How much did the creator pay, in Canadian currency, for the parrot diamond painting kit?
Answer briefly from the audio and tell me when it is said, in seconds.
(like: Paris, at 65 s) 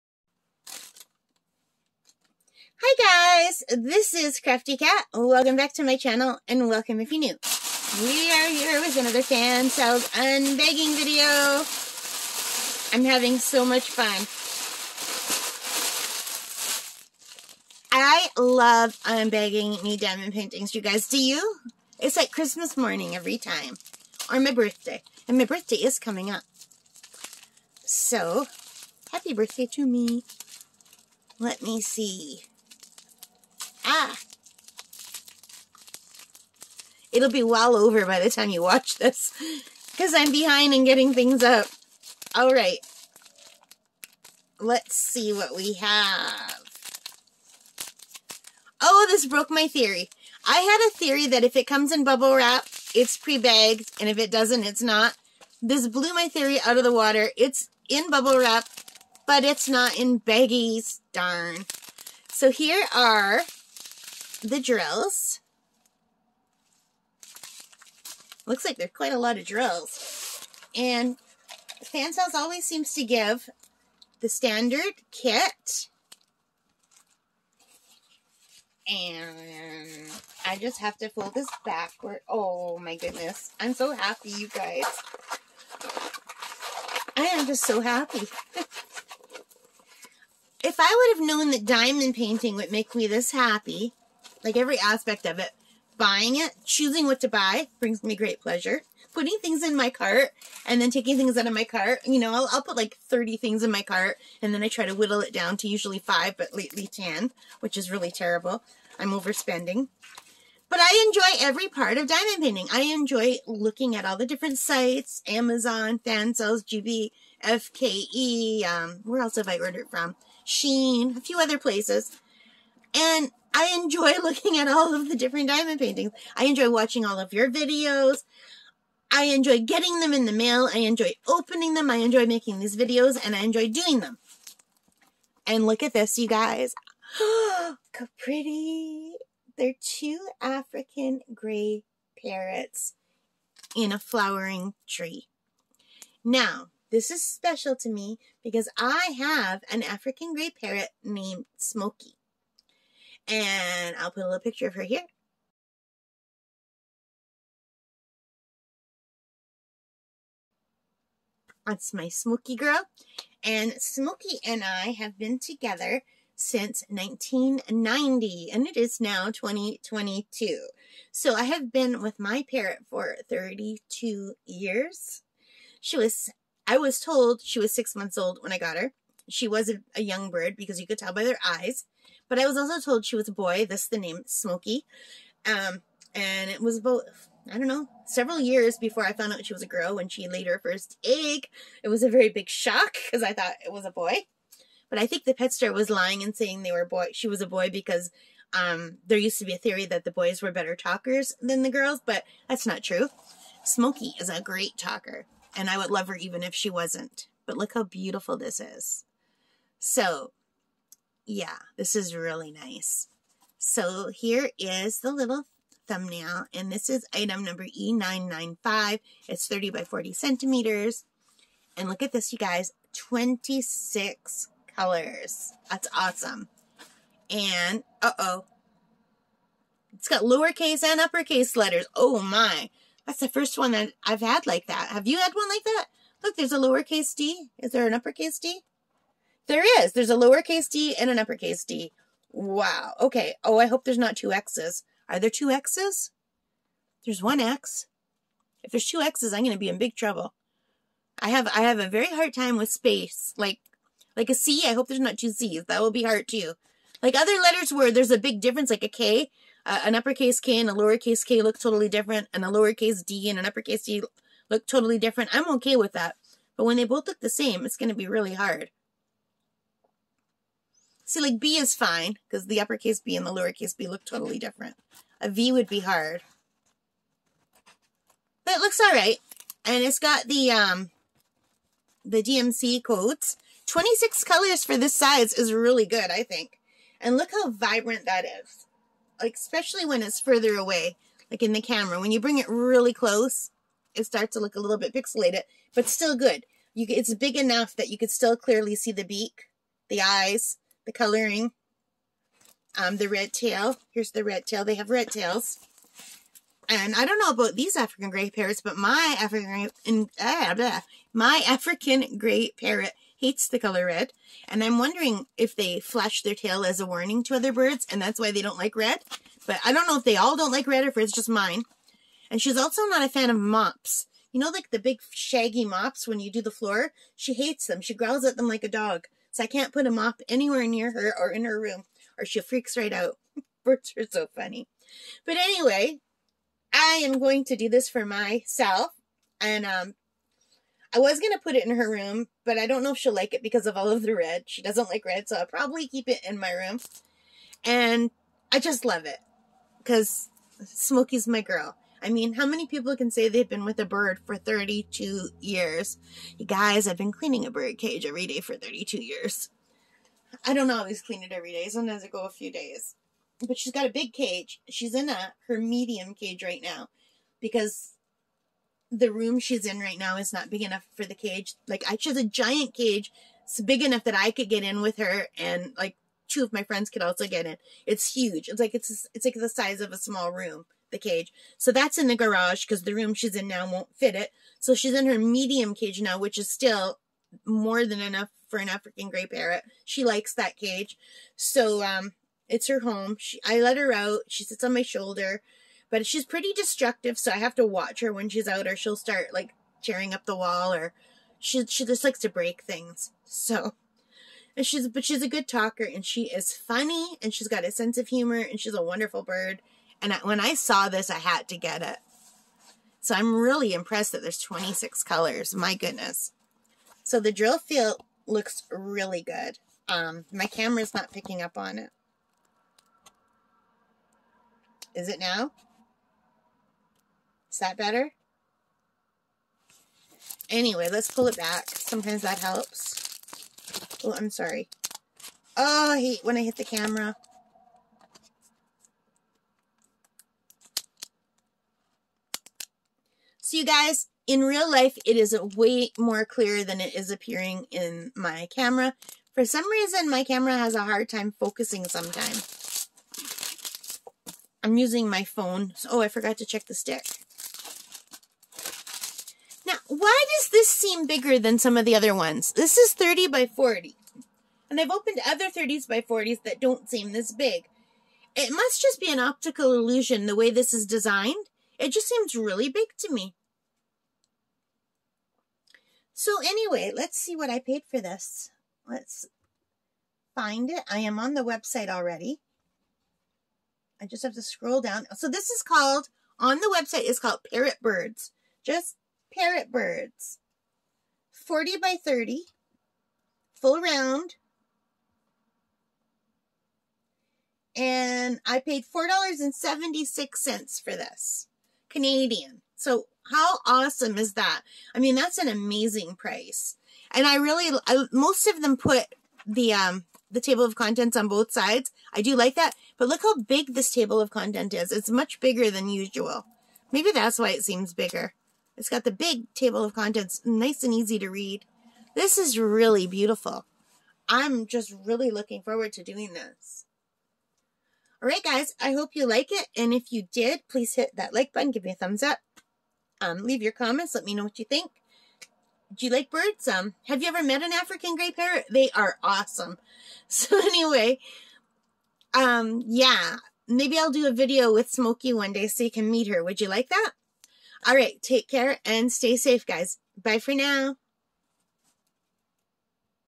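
$4.76, at 498 s.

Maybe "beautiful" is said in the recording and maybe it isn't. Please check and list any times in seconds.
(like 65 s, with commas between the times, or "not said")
207 s, 523 s.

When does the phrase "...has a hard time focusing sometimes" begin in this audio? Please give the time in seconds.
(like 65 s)
450 s.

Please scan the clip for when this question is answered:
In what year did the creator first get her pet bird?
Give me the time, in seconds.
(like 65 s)
166 s.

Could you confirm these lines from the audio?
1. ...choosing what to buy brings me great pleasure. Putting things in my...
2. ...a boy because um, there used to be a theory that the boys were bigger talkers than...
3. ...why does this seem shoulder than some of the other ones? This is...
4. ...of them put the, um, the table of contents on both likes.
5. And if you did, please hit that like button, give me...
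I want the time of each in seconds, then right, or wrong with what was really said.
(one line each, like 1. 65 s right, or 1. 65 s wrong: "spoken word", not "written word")
1. 96 s right
2. 197 s wrong: "better", not "bigger"
3. 459 s wrong: "bigger", not "shoulder"
4. 508 s wrong: "sides", not "likes"
5. 529 s right.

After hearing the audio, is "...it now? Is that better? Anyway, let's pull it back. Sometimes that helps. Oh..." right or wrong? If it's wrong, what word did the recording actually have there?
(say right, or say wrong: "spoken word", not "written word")
right.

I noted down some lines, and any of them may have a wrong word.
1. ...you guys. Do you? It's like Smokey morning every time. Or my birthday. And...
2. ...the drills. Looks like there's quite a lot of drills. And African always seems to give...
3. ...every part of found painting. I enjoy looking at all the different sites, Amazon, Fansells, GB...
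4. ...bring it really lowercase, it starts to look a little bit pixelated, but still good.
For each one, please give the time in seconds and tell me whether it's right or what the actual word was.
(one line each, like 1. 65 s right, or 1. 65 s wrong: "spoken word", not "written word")
1. 20 s wrong: "Christmas", not "Smokey"
2. 64 s wrong: "Fansells", not "African"
3. 111 s wrong: "diamond", not "found"
4. 292 s wrong: "close", not "lowercase".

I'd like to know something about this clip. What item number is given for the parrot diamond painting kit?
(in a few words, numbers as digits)
E995.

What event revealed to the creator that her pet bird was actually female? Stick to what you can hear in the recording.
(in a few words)
laid her first egg.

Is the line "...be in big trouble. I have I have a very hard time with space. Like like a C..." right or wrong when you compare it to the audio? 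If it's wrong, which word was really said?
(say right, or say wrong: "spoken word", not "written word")
right.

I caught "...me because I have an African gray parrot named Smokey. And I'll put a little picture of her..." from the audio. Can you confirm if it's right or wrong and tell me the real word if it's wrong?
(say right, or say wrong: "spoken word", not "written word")
right.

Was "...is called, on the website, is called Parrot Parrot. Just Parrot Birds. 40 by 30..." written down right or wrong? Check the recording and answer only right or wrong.
wrong.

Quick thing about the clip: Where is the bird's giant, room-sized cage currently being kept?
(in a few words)
the garage.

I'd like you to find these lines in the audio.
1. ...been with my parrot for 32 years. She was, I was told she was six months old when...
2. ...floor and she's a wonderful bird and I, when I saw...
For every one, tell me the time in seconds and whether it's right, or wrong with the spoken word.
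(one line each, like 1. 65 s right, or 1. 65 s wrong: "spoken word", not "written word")
1. 171 s right
2. 408 s wrong: "humor", not "floor".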